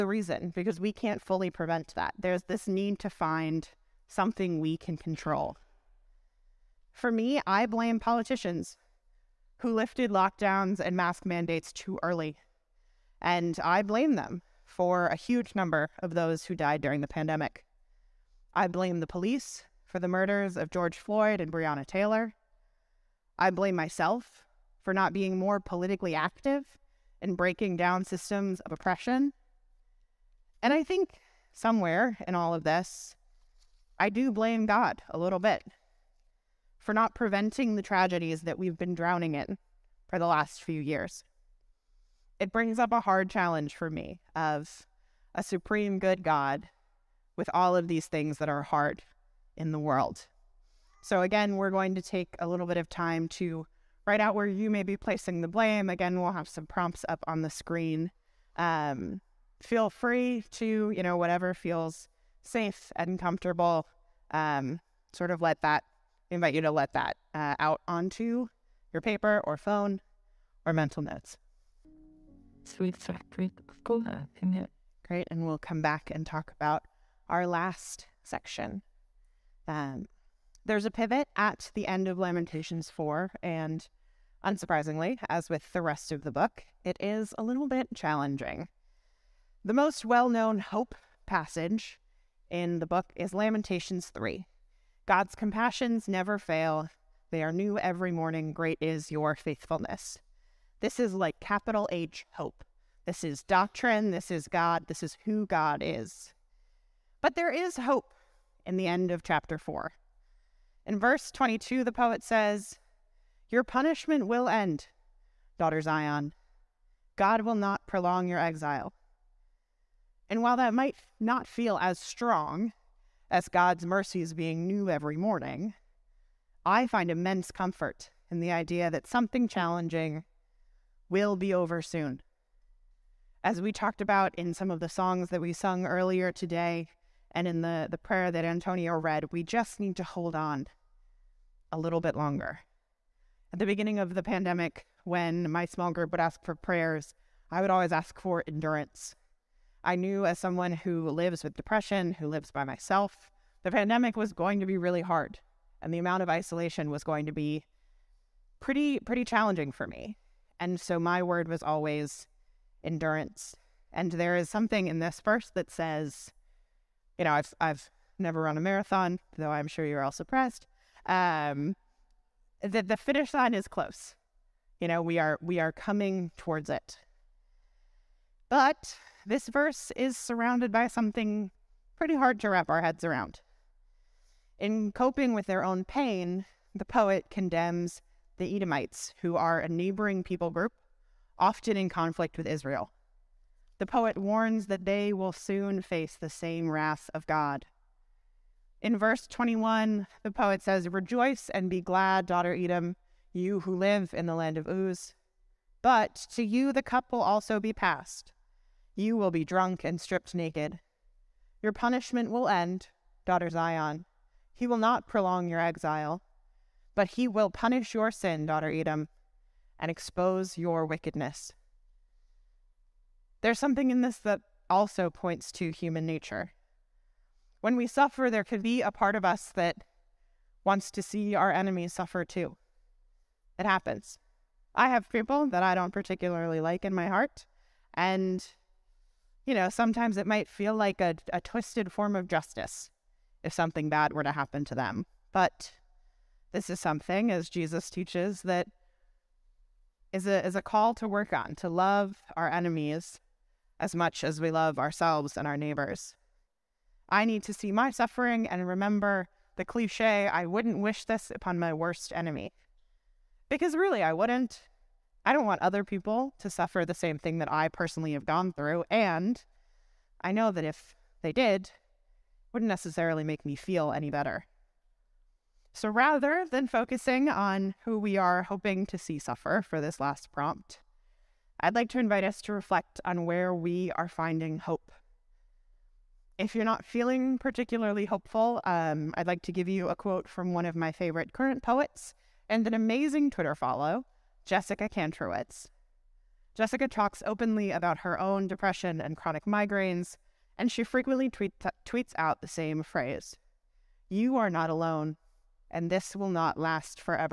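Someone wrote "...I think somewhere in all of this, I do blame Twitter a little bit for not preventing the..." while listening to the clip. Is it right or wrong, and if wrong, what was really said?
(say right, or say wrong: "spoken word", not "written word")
wrong: "God", not "Twitter".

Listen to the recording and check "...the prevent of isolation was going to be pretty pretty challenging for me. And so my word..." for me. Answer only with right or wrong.
wrong.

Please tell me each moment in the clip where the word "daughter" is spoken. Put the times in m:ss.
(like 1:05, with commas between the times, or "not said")
1:55, 3:22, 3:33, 3:38.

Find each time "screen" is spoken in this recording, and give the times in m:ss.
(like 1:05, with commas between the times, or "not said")
0:57.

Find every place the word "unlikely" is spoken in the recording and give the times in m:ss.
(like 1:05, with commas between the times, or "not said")
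not said.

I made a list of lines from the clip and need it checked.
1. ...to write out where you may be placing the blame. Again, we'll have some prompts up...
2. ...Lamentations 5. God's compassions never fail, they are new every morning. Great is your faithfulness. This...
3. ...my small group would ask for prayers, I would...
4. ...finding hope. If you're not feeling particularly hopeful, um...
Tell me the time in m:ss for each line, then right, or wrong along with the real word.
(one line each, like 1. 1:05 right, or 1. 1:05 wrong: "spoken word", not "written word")
1. 0:53 right
2. 1:33 wrong: "3", not "5"
3. 2:25 right
4. 4:44 right.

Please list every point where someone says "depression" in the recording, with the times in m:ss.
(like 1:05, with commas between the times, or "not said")
2:31, 4:58.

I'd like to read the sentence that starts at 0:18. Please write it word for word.
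I blame the police for the murders of George Floyd and Breonna Taylor.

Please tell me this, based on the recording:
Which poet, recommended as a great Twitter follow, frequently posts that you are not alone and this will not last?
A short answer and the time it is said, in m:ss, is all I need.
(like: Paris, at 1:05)
Jessica Kantrowitz, at 4:54.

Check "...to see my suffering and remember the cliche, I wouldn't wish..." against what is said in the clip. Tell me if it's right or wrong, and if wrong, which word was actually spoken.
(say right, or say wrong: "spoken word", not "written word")
right.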